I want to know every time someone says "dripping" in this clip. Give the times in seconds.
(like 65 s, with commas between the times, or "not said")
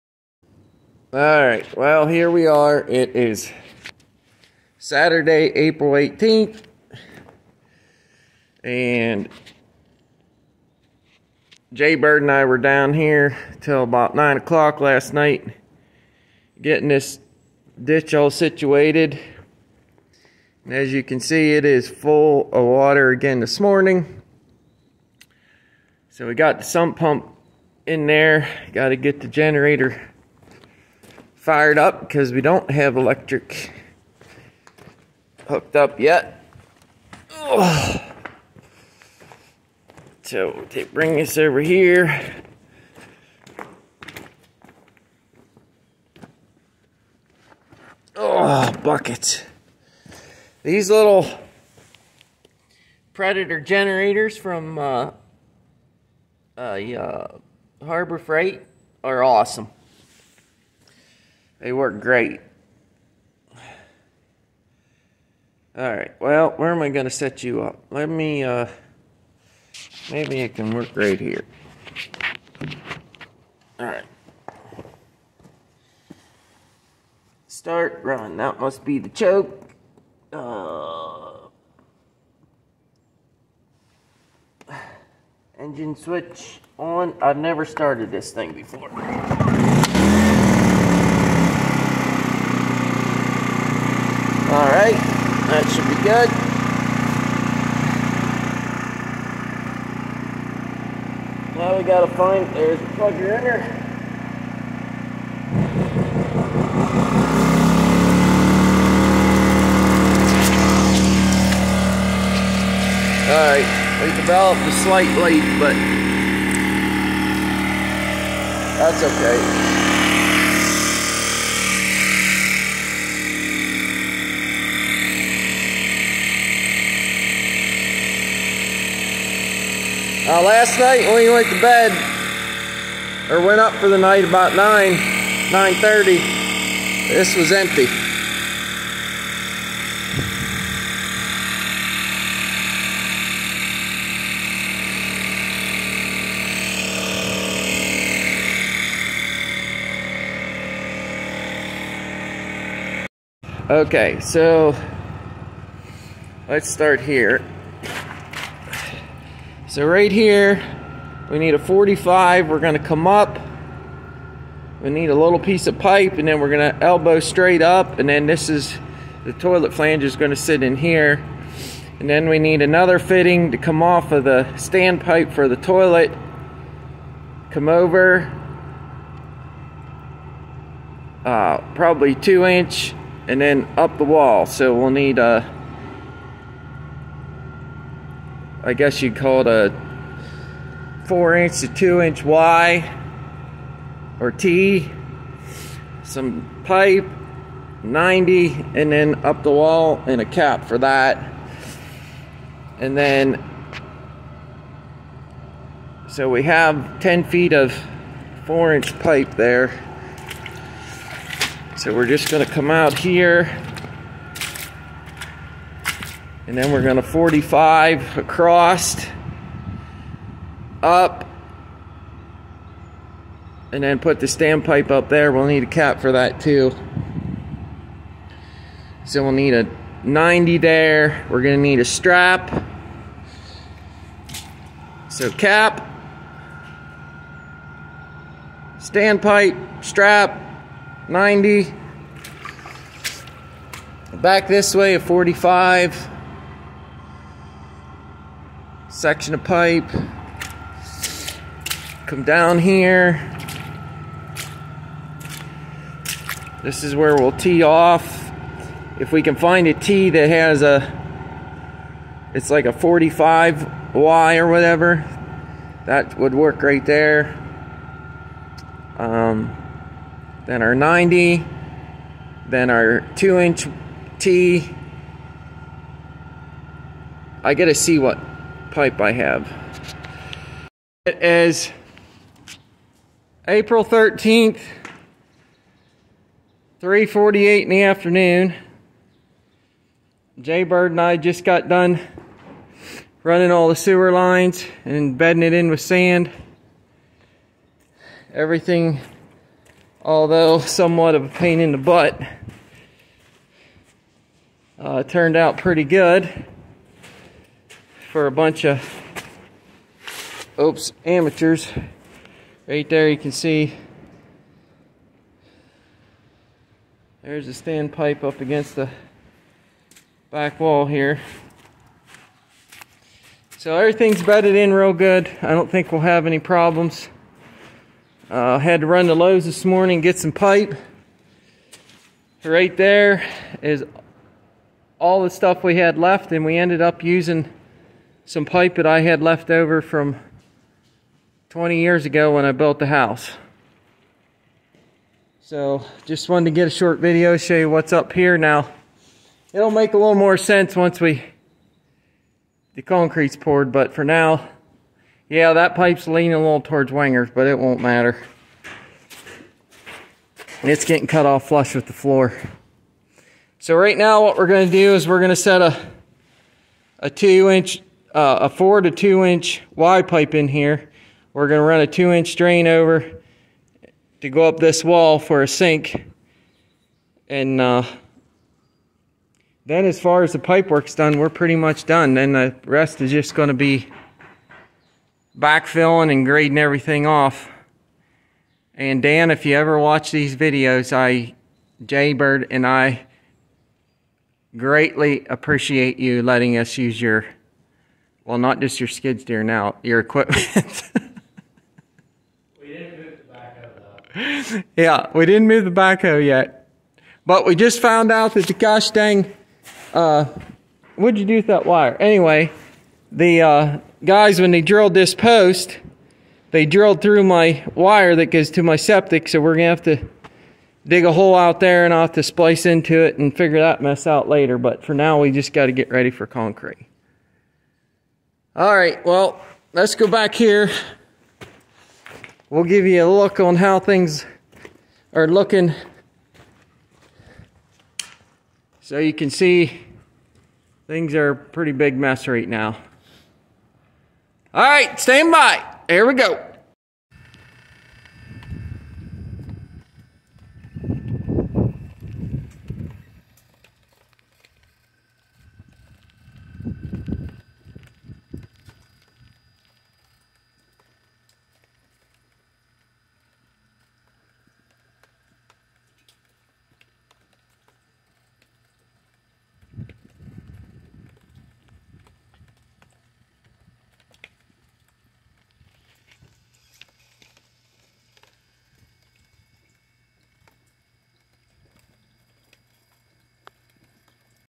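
not said.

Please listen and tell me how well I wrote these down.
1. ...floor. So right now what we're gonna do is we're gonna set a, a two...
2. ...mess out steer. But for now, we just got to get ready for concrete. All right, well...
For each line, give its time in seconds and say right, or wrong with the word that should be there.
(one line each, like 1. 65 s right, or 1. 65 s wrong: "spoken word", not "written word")
1. 361 s right
2. 423 s wrong: "later", not "steer".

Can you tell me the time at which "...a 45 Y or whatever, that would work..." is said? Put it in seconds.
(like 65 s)
262 s.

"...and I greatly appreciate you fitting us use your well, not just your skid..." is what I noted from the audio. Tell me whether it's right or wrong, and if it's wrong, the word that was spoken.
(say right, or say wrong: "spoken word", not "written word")
wrong: "letting", not "fitting".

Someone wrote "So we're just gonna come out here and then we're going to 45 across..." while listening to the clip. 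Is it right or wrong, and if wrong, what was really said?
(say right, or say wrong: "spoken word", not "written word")
right.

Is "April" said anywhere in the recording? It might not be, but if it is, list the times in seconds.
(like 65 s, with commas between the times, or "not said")
5 s, 283 s.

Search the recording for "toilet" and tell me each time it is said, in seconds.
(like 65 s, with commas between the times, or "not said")
169 s, 175 s.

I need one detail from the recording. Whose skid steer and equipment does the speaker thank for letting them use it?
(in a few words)
Dan.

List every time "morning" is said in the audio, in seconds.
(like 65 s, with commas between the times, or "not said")
23 s, 329 s.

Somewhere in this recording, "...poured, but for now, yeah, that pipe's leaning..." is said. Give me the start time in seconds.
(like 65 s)
353 s.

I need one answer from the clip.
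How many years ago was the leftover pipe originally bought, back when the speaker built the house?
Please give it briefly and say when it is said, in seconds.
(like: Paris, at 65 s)
20, at 341 s.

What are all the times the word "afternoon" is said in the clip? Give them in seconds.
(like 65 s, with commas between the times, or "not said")
287 s.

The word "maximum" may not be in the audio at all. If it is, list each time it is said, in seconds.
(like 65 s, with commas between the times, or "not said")
not said.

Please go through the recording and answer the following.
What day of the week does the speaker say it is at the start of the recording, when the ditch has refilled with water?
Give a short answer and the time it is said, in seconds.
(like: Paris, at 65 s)
Saturday, at 4 s.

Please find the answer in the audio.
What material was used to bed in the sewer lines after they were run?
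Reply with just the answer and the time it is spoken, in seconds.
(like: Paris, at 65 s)
sand, at 295 s.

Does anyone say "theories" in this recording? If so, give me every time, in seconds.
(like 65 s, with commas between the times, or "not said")
not said.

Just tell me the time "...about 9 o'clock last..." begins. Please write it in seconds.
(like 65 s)
13 s.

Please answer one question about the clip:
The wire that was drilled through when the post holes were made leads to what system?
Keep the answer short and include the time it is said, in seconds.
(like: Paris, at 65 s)
septic, at 418 s.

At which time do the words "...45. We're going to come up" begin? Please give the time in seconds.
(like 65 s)
161 s.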